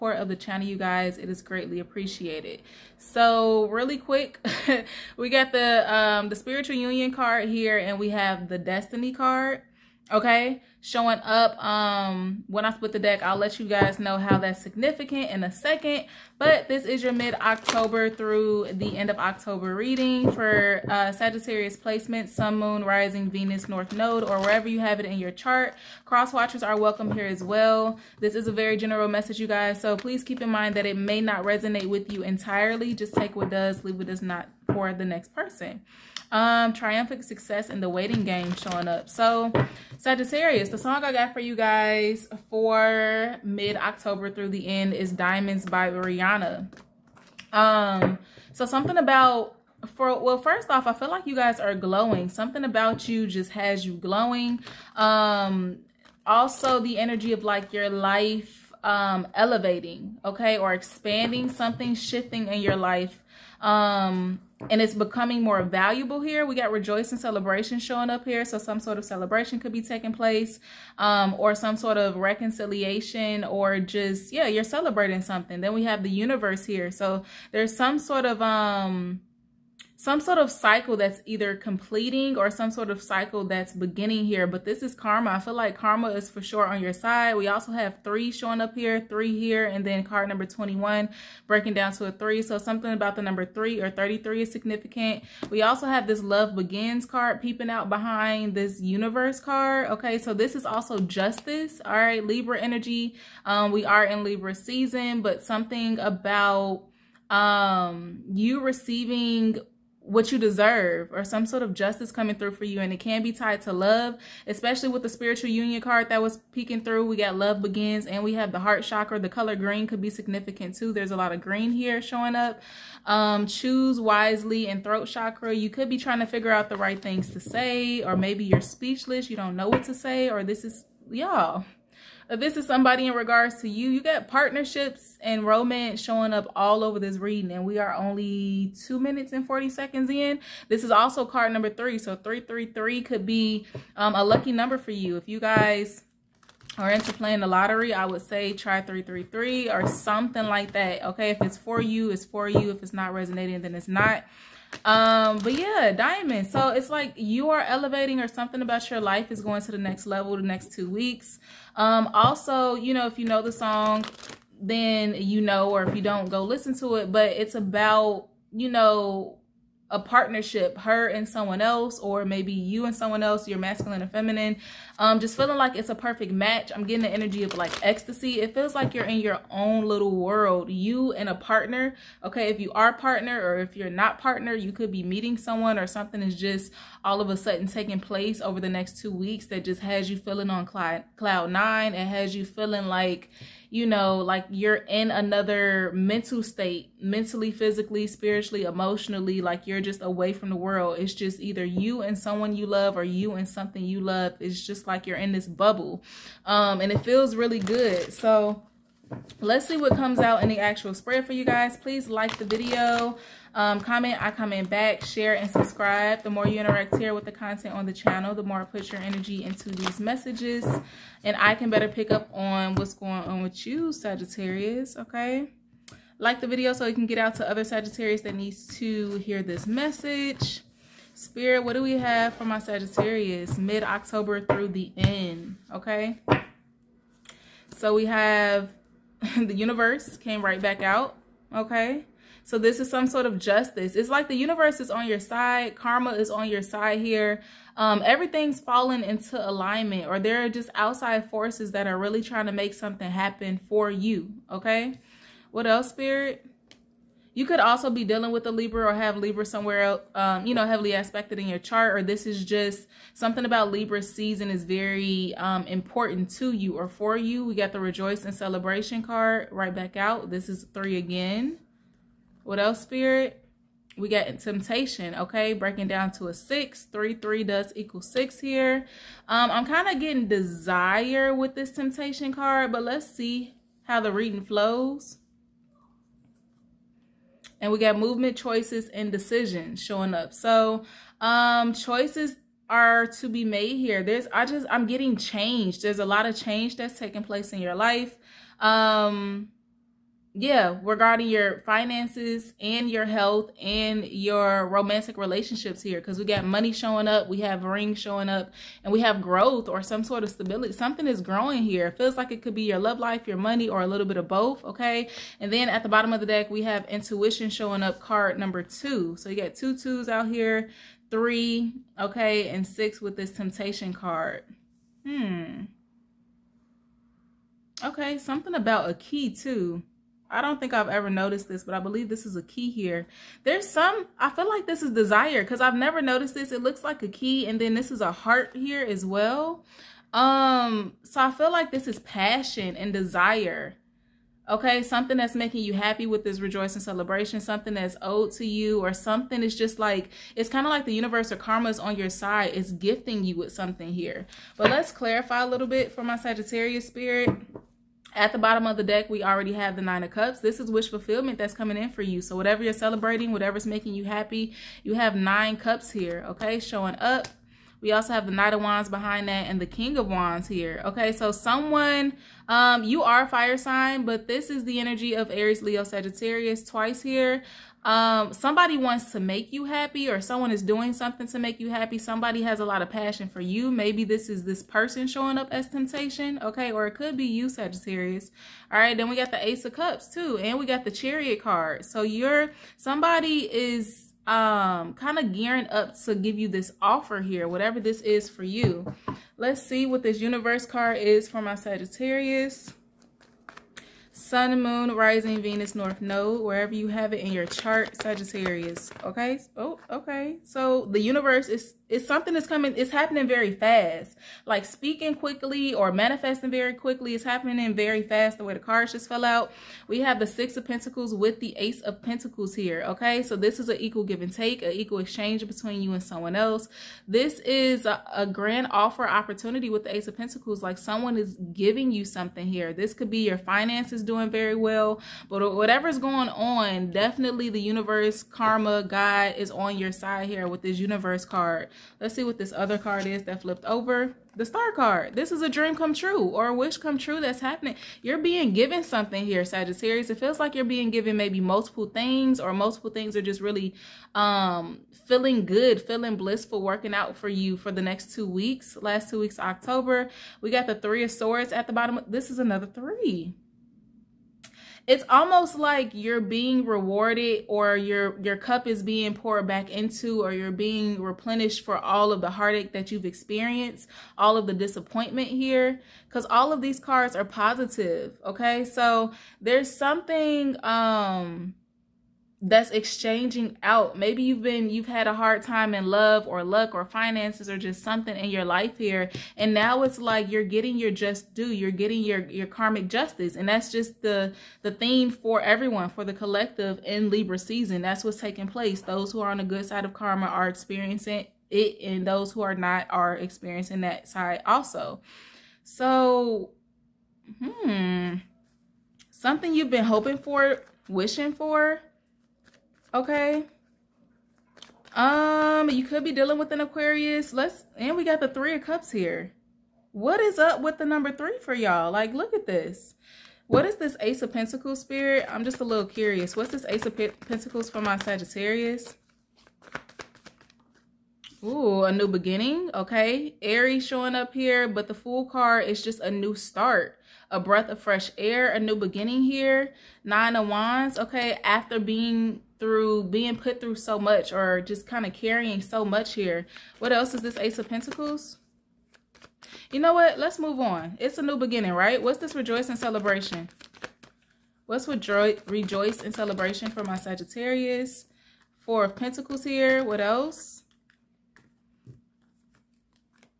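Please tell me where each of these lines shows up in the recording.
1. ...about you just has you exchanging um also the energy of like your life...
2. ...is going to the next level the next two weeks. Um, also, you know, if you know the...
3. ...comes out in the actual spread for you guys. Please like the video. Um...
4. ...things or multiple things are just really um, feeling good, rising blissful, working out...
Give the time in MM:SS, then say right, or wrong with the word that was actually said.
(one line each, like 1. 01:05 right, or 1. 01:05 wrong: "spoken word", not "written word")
1. 00:52 wrong: "glowing", not "exchanging"
2. 02:39 right
3. 03:29 right
4. 07:31 wrong: "feeling", not "rising".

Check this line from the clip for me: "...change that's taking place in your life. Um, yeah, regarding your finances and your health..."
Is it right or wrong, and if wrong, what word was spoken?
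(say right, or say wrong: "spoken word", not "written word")
right.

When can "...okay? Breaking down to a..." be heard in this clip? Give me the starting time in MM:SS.
04:35.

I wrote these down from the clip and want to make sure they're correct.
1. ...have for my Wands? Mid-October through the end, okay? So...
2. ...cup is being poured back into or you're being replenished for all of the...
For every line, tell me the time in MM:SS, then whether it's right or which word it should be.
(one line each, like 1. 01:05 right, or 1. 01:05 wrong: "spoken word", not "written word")
1. 03:51 wrong: "Sagittarius", not "Wands"
2. 07:48 right.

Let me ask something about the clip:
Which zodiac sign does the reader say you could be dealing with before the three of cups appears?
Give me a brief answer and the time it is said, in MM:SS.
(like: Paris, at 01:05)
Aquarius, at 08:36.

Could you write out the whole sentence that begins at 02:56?
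I'm getting the energy of like ecstasy.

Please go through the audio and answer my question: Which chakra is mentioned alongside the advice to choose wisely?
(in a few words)
Throat chakra.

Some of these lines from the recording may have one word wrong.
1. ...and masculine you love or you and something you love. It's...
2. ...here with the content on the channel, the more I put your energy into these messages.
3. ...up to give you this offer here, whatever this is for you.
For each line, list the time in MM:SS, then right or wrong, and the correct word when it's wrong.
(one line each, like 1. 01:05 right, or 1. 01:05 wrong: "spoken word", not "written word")
1. 03:22 wrong: "someone", not "masculine"
2. 03:36 right
3. 06:35 right.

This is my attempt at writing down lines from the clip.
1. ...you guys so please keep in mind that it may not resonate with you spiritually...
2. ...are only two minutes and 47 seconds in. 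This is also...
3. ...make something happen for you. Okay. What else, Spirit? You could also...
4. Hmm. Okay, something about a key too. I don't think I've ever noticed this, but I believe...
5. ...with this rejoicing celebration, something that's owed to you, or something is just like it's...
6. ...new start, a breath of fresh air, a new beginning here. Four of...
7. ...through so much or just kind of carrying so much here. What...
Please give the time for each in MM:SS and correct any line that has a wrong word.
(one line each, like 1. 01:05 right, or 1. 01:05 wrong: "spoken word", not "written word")
1. 00:29 wrong: "entirely", not "spiritually"
2. 02:17 wrong: "40", not "47"
3. 04:12 right
4. 05:25 right
5. 05:46 right
6. 08:56 wrong: "Nine", not "Four"
7. 09:03 right.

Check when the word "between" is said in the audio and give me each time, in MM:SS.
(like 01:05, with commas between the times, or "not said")
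07:05.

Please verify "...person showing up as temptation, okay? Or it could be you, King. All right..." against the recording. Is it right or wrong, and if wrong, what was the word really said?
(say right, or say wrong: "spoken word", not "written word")
wrong: "Sagittarius", not "King".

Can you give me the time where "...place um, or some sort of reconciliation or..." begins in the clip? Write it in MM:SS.
01:10.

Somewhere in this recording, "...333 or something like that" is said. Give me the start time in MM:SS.
02:28.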